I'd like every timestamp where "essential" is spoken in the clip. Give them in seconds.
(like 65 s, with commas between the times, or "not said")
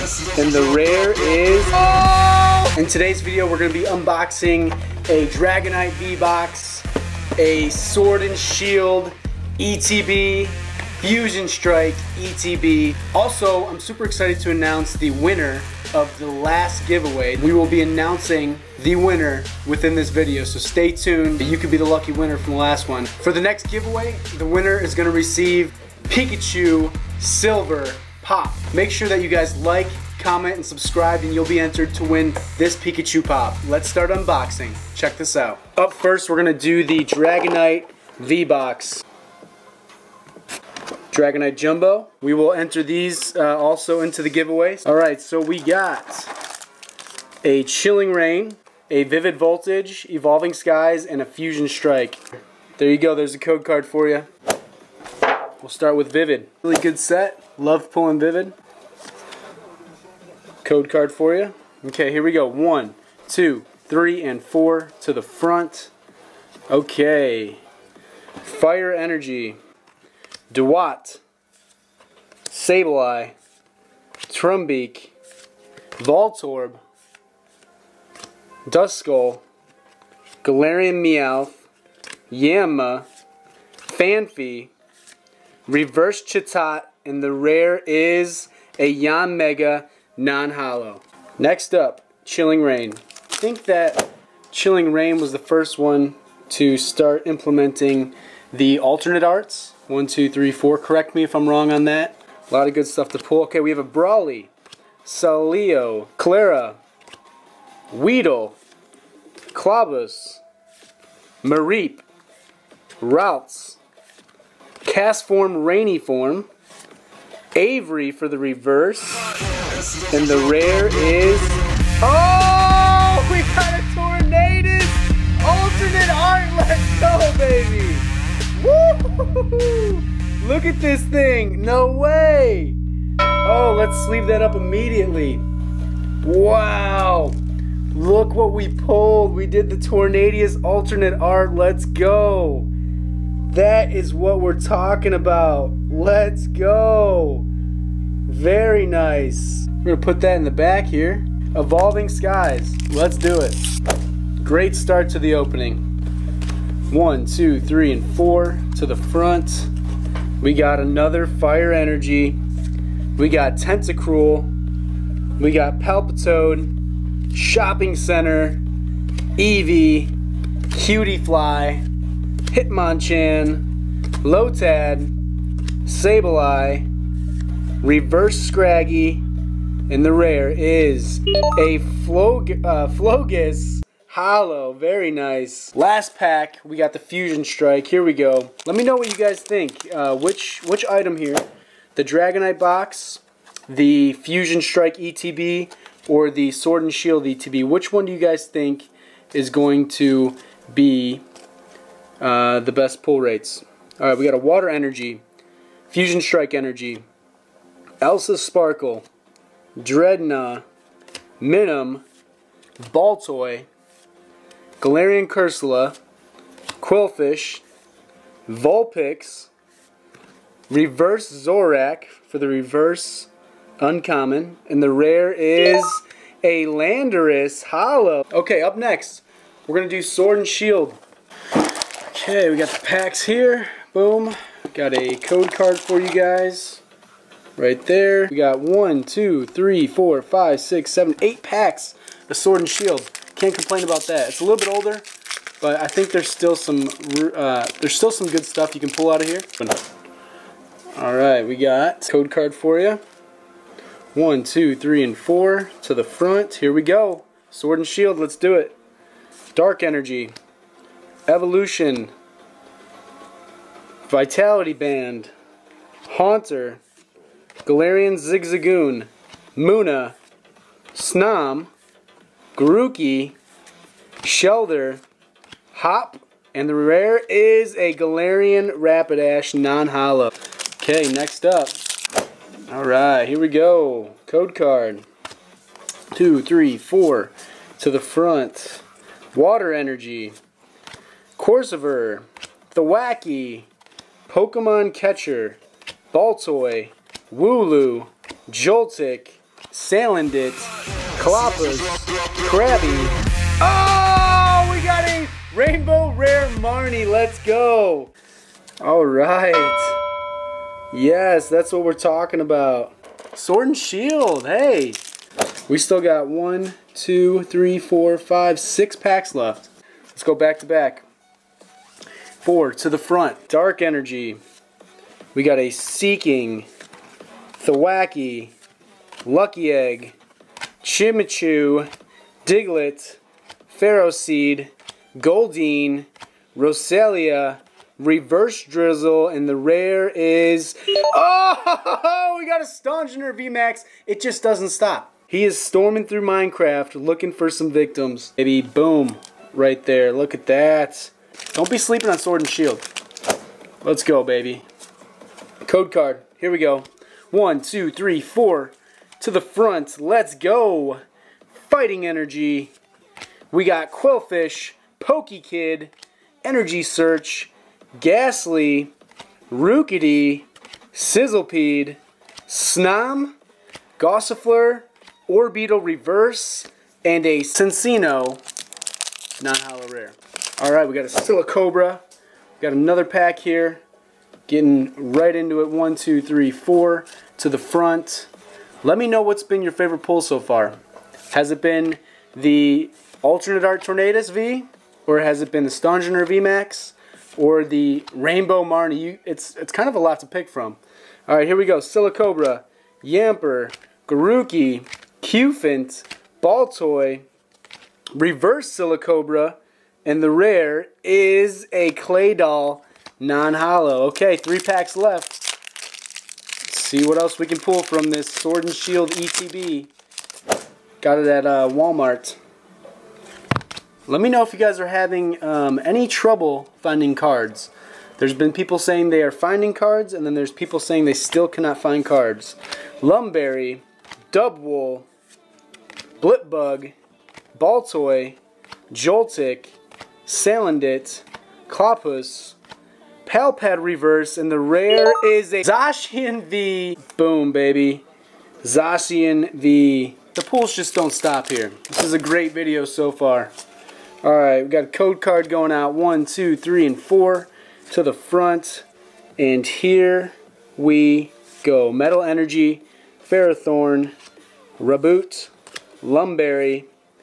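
not said.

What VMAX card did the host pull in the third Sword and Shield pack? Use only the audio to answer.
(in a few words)
Stonjourner VMAX.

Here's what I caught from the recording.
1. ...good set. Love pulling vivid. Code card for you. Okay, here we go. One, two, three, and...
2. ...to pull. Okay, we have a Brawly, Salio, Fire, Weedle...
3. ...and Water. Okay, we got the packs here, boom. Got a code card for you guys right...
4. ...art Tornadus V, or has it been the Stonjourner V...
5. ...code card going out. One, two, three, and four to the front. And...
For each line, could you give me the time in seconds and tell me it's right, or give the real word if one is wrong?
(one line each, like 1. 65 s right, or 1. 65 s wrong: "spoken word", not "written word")
1. 56 s right
2. 103 s wrong: "Klara", not "Fire"
3. 230 s wrong: "Shield", not "Water"
4. 393 s right
5. 454 s right.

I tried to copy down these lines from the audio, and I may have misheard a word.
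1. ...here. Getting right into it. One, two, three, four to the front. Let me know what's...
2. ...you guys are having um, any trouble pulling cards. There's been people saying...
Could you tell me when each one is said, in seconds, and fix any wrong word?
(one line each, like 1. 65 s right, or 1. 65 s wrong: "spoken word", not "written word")
1. 383 s right
2. 424 s wrong: "finding", not "pulling".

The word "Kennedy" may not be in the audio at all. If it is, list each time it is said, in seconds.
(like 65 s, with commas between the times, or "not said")
not said.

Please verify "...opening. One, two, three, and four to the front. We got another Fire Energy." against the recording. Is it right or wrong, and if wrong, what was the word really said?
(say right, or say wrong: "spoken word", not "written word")
right.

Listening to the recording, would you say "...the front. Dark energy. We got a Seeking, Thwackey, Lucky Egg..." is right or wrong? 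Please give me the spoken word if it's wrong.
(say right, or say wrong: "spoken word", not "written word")
right.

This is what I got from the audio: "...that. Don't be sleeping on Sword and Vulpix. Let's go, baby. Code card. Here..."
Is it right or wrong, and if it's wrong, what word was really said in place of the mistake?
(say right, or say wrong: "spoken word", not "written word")
wrong: "Shield", not "Vulpix".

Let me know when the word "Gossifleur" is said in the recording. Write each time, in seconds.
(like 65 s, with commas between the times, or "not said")
373 s.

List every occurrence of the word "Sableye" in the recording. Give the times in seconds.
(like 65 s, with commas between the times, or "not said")
72 s, 175 s.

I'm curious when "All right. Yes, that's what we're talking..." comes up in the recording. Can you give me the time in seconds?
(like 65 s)
308 s.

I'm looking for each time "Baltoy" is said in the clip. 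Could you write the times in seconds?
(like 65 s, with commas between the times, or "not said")
212 s, 296 s, 406 s, 437 s.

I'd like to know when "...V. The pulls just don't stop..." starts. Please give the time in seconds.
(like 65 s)
449 s.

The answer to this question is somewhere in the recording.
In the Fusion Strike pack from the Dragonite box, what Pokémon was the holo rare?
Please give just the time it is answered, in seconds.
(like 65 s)
226 s.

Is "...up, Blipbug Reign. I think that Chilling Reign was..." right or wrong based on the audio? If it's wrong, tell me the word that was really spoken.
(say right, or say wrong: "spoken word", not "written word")
wrong: "Chilling", not "Blipbug".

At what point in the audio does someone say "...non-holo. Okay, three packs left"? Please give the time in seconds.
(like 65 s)
413 s.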